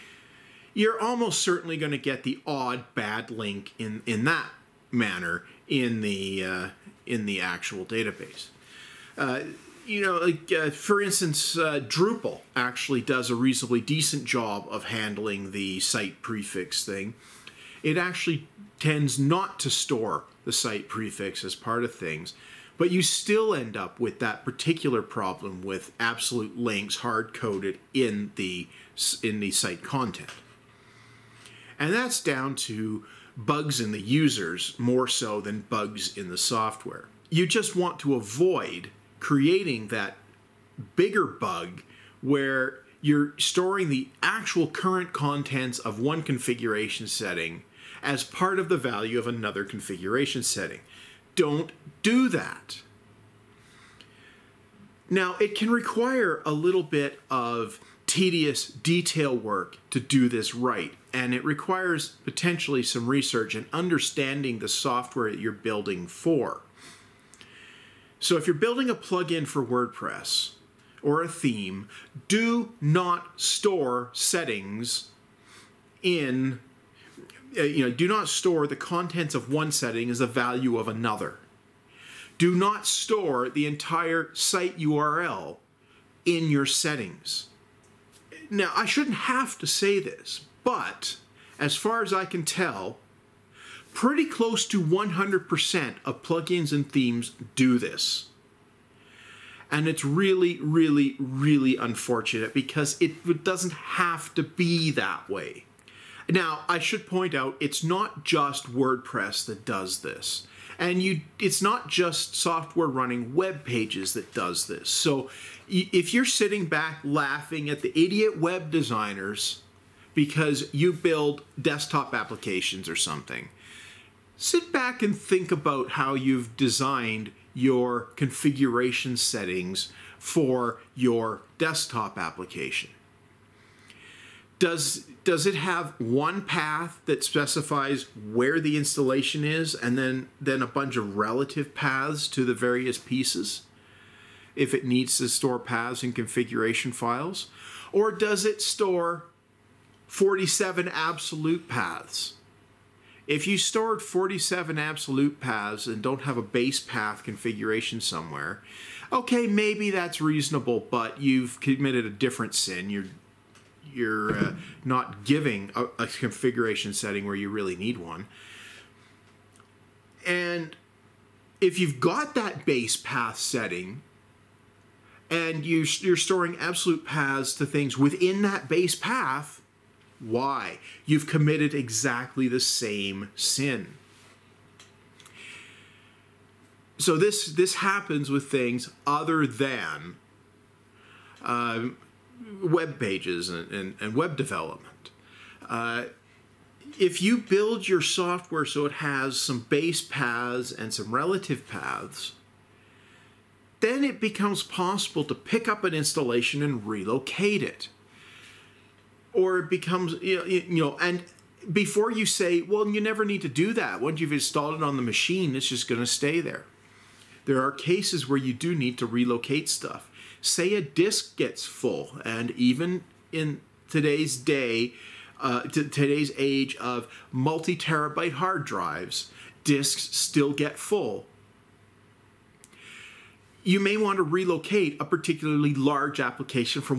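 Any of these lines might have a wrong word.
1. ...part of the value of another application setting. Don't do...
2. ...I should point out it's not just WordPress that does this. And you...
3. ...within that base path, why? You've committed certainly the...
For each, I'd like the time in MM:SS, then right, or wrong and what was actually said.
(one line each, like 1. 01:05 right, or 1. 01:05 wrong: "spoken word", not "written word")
1. 00:48 wrong: "configuration", not "application"
2. 01:46 right
3. 02:57 wrong: "exactly", not "certainly".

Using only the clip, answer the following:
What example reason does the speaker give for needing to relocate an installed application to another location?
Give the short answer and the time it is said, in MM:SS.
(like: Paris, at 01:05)
Disk gets full, at 03:40.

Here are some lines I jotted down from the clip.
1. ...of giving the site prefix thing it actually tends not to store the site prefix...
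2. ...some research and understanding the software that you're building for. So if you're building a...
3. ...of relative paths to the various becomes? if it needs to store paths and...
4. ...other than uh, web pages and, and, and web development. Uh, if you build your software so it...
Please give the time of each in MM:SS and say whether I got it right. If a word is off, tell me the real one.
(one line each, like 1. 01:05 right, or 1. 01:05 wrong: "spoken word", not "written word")
1. 00:14 wrong: "handling", not "giving"
2. 01:02 right
3. 02:20 wrong: "pieces", not "becomes"
4. 03:09 right.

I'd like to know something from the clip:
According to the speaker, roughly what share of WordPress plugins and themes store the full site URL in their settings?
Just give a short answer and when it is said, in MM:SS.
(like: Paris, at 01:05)
100%, at 01:34.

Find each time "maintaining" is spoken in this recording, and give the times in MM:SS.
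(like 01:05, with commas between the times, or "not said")
not said.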